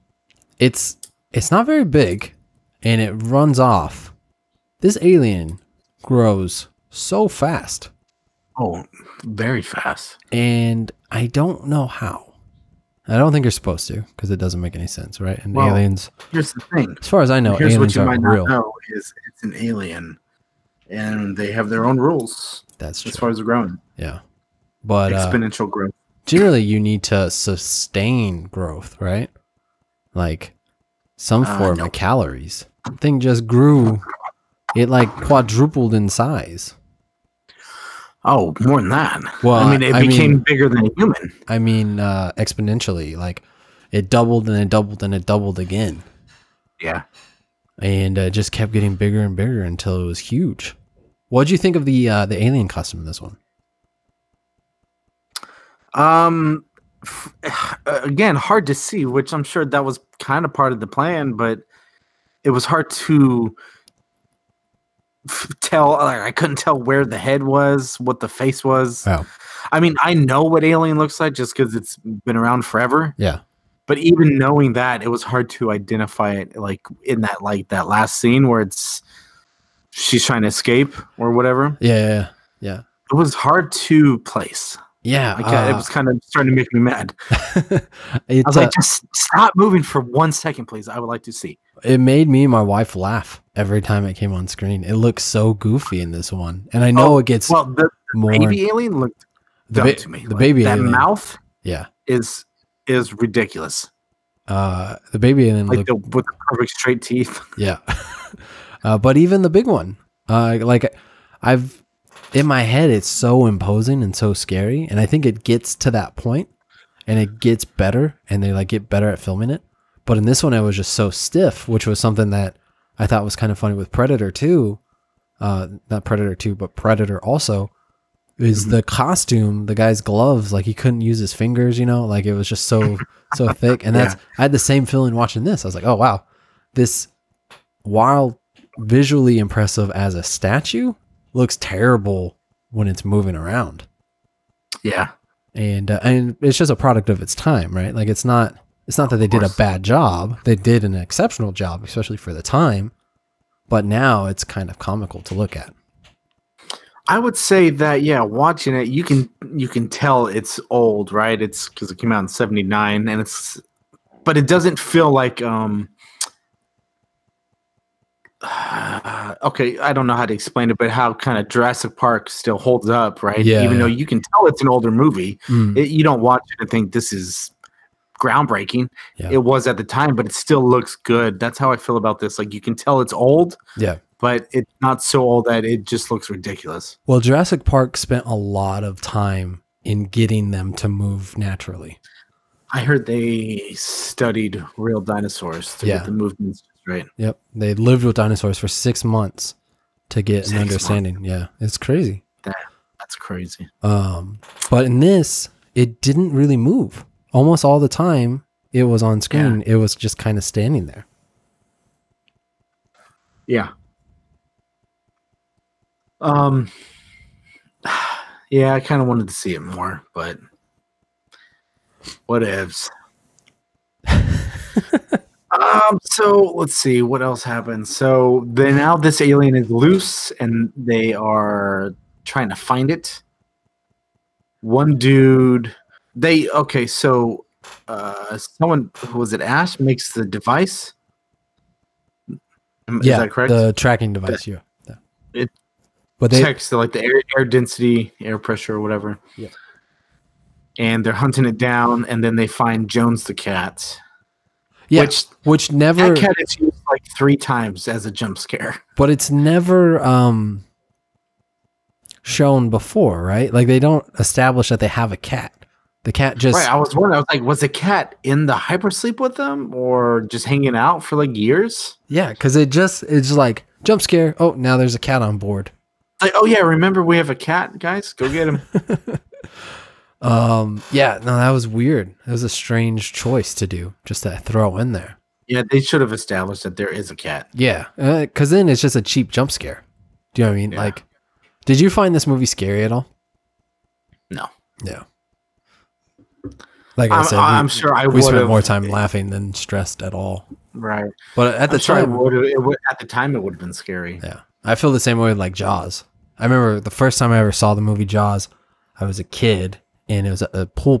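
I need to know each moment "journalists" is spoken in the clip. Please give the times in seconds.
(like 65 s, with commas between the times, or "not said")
not said.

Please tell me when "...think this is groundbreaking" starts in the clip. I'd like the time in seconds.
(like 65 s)
176 s.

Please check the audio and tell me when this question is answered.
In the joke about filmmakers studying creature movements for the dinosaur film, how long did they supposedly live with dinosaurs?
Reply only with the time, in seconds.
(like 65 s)
198 s.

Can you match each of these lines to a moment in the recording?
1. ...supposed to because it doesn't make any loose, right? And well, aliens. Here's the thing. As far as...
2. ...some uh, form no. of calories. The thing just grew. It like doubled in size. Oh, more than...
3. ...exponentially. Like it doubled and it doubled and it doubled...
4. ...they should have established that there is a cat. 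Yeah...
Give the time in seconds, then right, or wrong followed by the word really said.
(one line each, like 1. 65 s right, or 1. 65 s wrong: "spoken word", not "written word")
1. 13 s wrong: "sense", not "loose"
2. 31 s wrong: "quadrupled", not "doubled"
3. 42 s right
4. 285 s right.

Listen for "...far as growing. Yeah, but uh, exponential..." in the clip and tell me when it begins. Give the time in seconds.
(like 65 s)
23 s.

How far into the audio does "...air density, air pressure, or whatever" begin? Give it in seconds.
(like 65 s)
247 s.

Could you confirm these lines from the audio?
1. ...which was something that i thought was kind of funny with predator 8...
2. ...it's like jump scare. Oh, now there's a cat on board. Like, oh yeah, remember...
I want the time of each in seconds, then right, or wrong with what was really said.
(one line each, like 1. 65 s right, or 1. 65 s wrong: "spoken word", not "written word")
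1. 121 s wrong: "2", not "8"
2. 273 s right.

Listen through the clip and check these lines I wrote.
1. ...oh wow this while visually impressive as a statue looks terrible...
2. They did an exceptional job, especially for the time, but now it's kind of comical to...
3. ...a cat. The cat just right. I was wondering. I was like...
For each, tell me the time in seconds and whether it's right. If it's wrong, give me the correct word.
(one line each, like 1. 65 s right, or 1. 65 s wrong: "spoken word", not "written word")
1. 135 s right
2. 150 s right
3. 265 s right.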